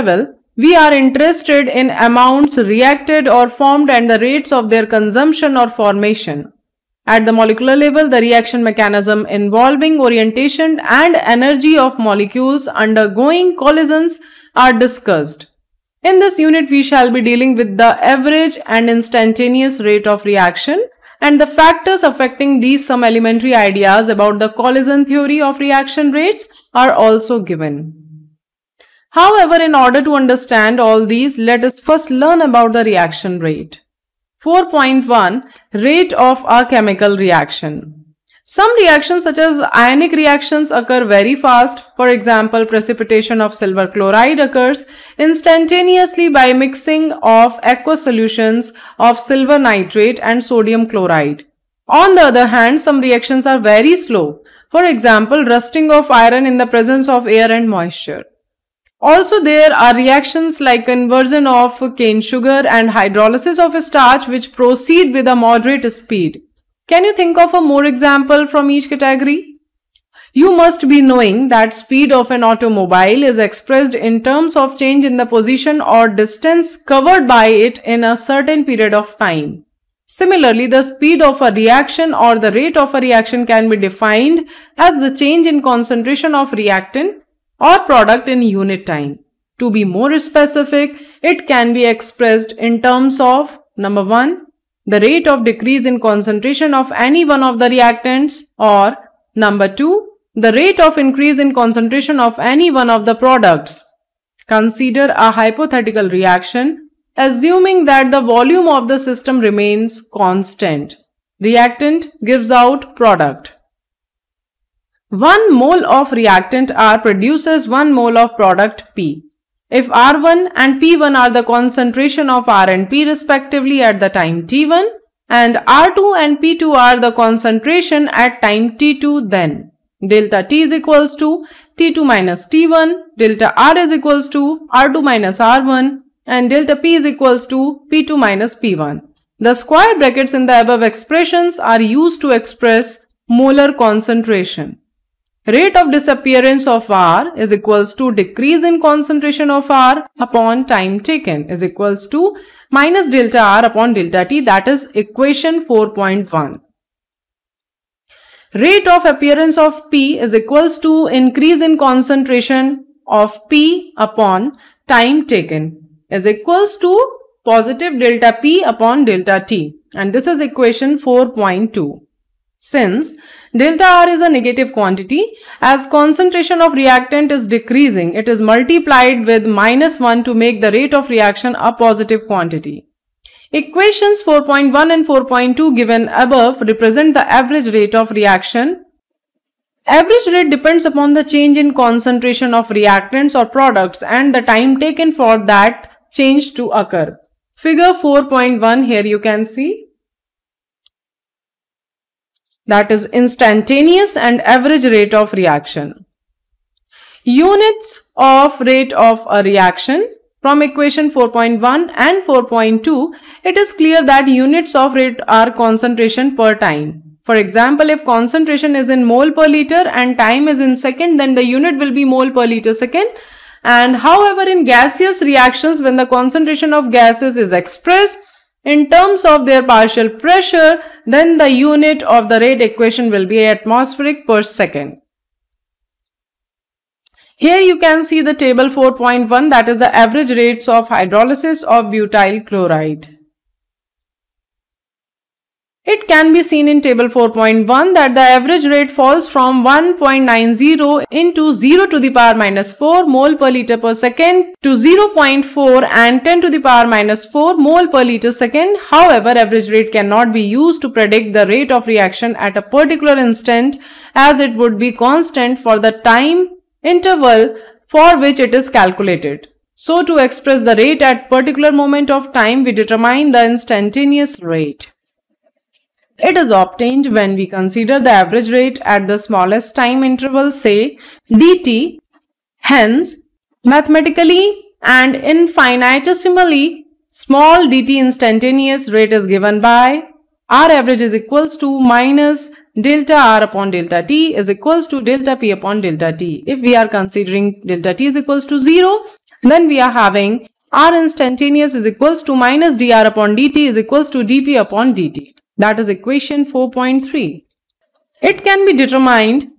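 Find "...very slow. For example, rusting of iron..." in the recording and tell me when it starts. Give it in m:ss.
0:53.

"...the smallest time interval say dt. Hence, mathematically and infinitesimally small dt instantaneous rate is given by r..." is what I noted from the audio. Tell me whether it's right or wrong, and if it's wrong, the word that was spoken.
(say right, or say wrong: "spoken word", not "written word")
right.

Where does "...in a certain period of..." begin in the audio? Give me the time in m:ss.
1:17.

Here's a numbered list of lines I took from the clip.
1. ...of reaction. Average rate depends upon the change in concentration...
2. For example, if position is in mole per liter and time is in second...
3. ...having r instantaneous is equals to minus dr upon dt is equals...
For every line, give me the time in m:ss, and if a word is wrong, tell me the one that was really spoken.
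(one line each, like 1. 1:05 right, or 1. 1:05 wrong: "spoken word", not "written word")
1. 3:07 right
2. 3:37 wrong: "concentration", not "position"
3. 4:59 right.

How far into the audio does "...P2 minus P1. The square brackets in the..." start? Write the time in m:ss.
2:17.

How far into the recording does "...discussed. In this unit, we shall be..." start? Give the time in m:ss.
0:14.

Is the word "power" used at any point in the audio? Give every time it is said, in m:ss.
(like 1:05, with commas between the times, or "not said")
4:12, 4:16.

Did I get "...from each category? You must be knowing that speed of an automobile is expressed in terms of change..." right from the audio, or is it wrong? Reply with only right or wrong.
right.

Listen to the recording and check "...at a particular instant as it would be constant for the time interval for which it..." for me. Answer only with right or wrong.
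right.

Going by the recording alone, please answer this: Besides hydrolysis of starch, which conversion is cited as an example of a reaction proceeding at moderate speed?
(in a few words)
conversion of cane sugar.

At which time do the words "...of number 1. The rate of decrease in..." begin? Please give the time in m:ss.
1:33.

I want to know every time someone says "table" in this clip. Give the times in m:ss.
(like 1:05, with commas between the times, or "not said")
3:58, 4:06.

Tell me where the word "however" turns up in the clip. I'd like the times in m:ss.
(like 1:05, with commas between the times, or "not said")
0:29, 3:43, 4:18.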